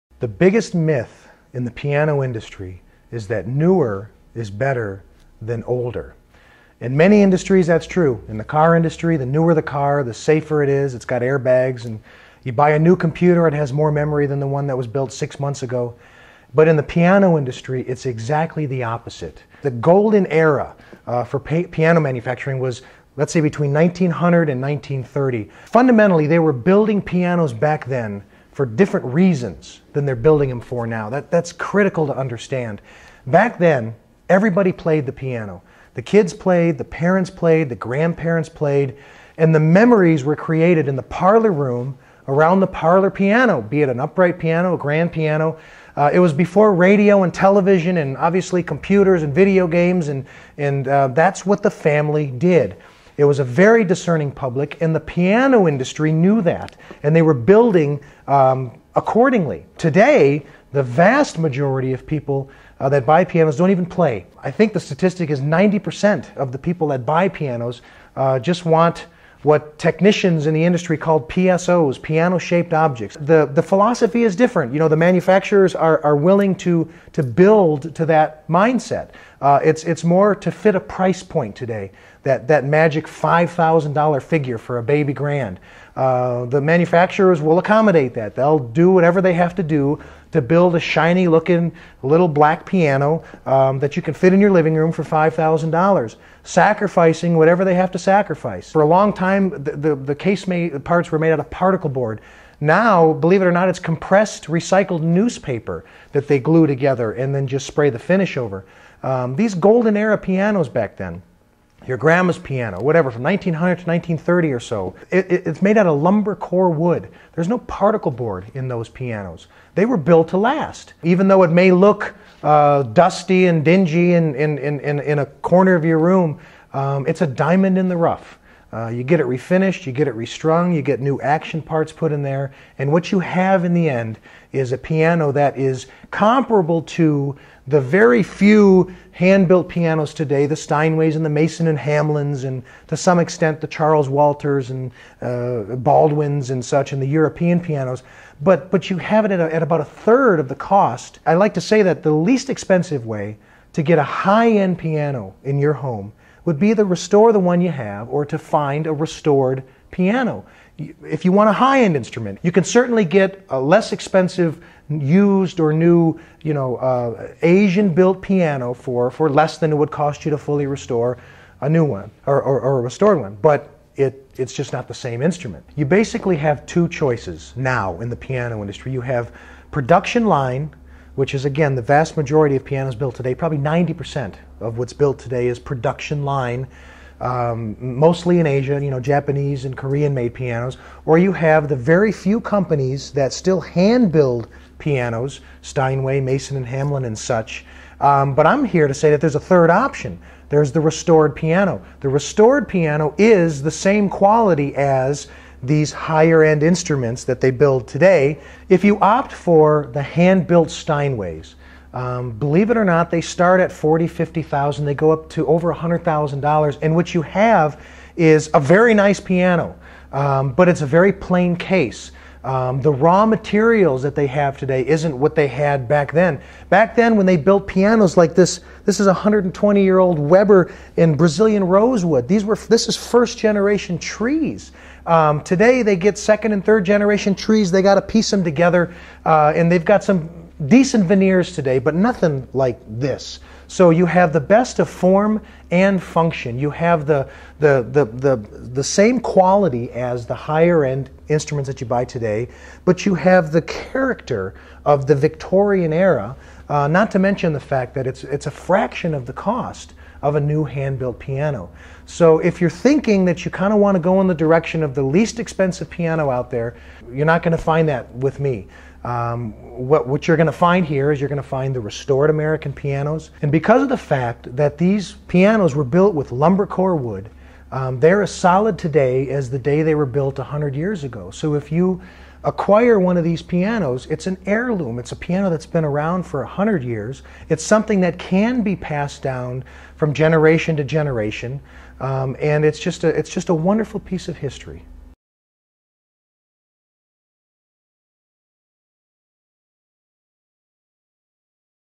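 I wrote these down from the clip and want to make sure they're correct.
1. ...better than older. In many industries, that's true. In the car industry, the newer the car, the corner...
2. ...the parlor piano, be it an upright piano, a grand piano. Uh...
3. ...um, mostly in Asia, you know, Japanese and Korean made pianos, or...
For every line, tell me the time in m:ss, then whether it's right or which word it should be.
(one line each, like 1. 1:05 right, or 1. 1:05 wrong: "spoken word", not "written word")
1. 0:04 wrong: "safer", not "corner"
2. 0:42 right
3. 3:07 right.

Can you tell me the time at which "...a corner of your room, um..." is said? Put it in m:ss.
2:05.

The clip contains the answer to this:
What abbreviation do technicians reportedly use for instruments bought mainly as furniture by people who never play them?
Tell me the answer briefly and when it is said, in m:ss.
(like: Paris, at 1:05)
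PSOs, at 1:11.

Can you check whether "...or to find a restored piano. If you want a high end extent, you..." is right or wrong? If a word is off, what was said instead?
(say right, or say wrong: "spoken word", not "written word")
wrong: "instrument", not "extent".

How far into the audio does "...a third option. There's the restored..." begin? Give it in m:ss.
3:19.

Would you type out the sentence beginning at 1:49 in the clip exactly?
Um, these golden era pianos back then your grandma's piano, whatever, from 1900 to 1930 or so.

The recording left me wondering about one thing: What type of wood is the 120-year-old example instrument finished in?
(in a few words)
Brazilian rosewood.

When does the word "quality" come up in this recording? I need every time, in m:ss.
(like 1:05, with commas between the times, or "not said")
3:24, 4:09.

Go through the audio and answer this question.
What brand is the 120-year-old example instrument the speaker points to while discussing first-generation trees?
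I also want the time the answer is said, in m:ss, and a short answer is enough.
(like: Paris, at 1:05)
Weber, at 3:50.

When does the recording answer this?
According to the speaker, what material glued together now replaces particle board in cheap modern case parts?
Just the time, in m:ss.
1:43.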